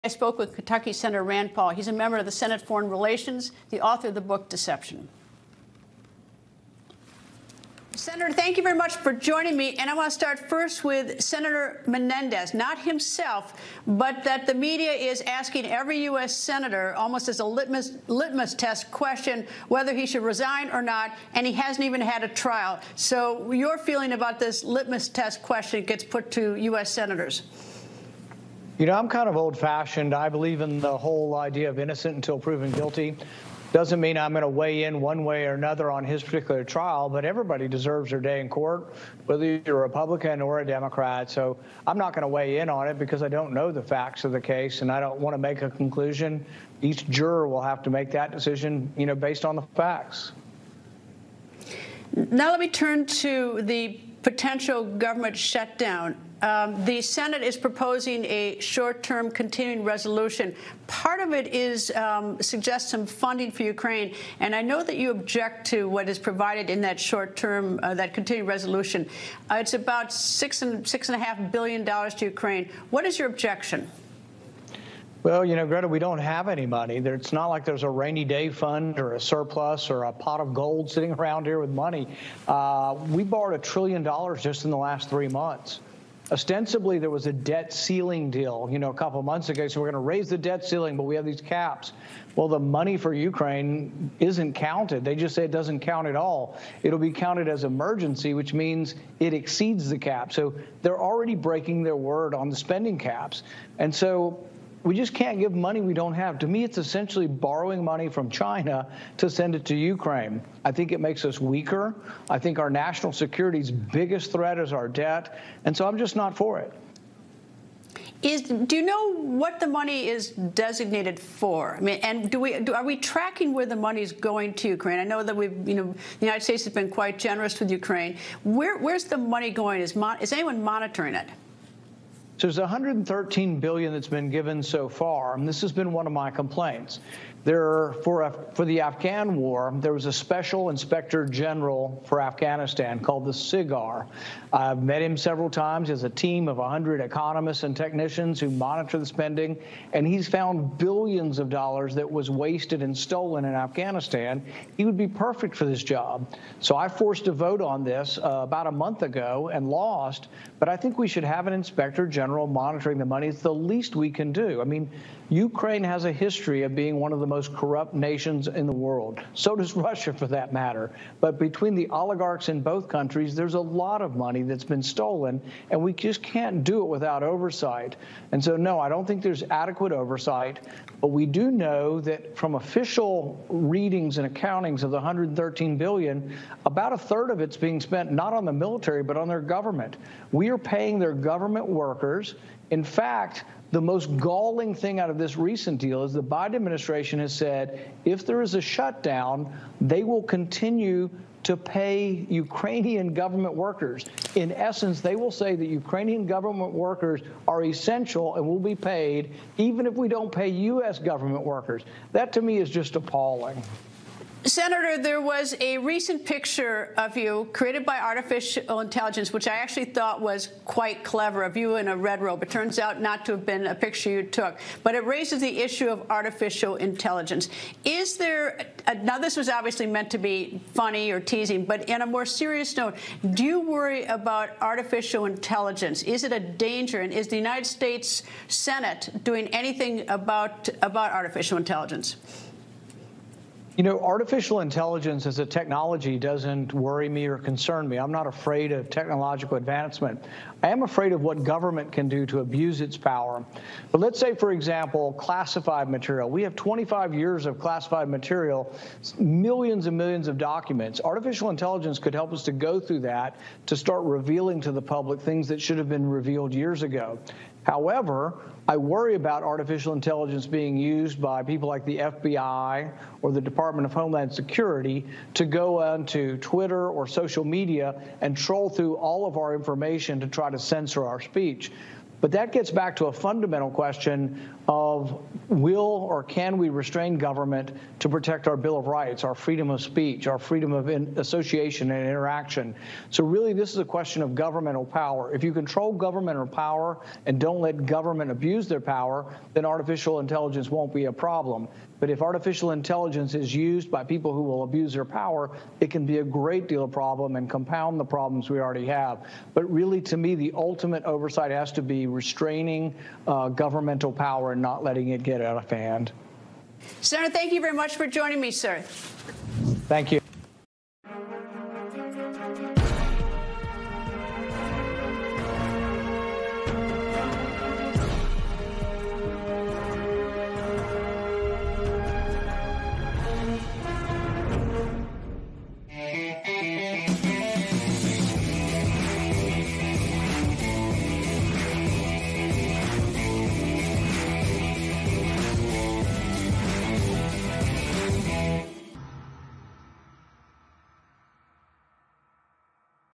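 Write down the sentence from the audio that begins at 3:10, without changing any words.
We are paying their government workers.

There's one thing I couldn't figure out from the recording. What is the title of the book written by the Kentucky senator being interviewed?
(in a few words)
Deception.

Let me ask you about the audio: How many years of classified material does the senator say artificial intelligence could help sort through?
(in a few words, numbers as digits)
25 years.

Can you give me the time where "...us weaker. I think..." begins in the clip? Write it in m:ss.
1:51.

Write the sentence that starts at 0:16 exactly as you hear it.
senator, almost as a litmus, litmus test question, whether he should resign or not, and he hasn't even had a trial.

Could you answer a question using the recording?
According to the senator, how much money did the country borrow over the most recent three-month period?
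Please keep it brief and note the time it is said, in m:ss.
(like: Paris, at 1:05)
a trillion dollars, at 1:23.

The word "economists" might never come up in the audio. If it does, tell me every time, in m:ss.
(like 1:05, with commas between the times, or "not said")
2:27.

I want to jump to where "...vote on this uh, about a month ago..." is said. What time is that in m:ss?
2:37.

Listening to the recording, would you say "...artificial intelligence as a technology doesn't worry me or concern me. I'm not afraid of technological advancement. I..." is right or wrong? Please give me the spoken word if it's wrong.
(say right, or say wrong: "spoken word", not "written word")
right.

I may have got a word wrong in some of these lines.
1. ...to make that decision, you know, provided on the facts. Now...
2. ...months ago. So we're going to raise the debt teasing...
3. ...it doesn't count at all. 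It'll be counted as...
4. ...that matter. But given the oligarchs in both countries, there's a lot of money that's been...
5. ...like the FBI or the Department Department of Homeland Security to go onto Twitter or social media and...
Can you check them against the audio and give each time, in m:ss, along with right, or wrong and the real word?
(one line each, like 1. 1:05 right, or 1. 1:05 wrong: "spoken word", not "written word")
1. 0:47 wrong: "based", not "provided"
2. 1:29 wrong: "ceiling", not "teasing"
3. 1:35 right
4. 2:50 wrong: "between", not "given"
5. 4:31 right.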